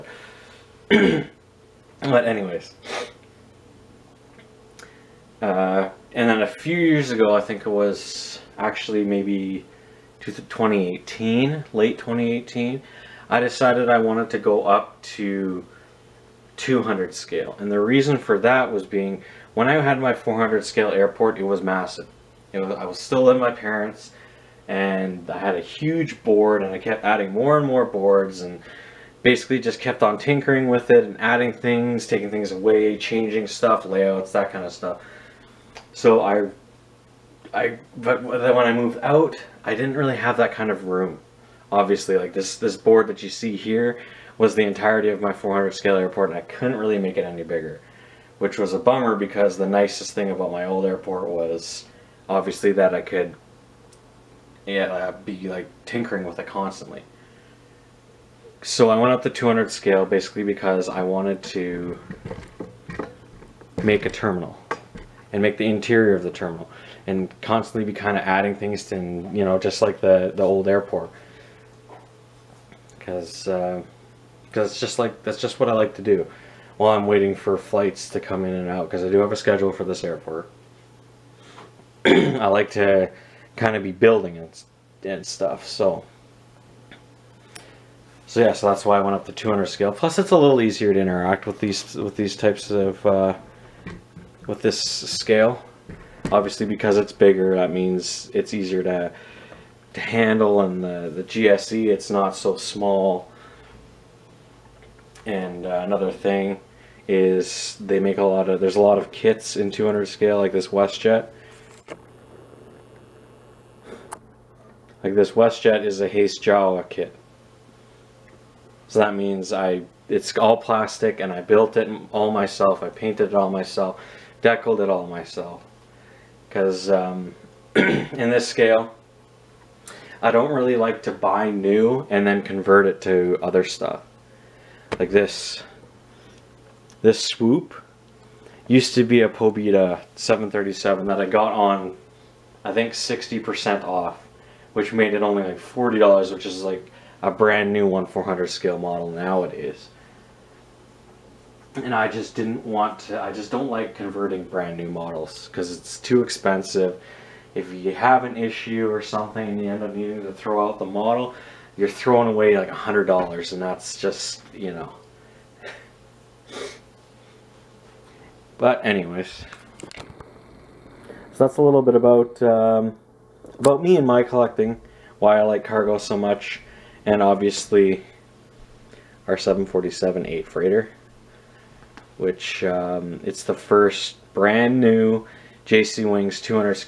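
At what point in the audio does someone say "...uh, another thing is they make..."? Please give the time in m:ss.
1:45.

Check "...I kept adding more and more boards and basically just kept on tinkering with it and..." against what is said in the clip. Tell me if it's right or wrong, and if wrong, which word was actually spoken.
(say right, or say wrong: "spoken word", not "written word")
right.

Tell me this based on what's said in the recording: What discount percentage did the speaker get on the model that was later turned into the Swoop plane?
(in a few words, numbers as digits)
60%.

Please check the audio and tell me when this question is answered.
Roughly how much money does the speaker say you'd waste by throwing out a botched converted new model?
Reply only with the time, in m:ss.
2:42.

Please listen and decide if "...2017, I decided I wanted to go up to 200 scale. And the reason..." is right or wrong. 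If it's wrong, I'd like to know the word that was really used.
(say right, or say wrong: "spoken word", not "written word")
wrong: "2018", not "2017".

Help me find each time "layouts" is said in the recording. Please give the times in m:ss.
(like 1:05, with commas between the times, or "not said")
0:33.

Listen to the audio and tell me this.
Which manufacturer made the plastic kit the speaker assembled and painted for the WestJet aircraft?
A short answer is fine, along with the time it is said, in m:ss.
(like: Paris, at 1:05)
Hasegawa, at 1:56.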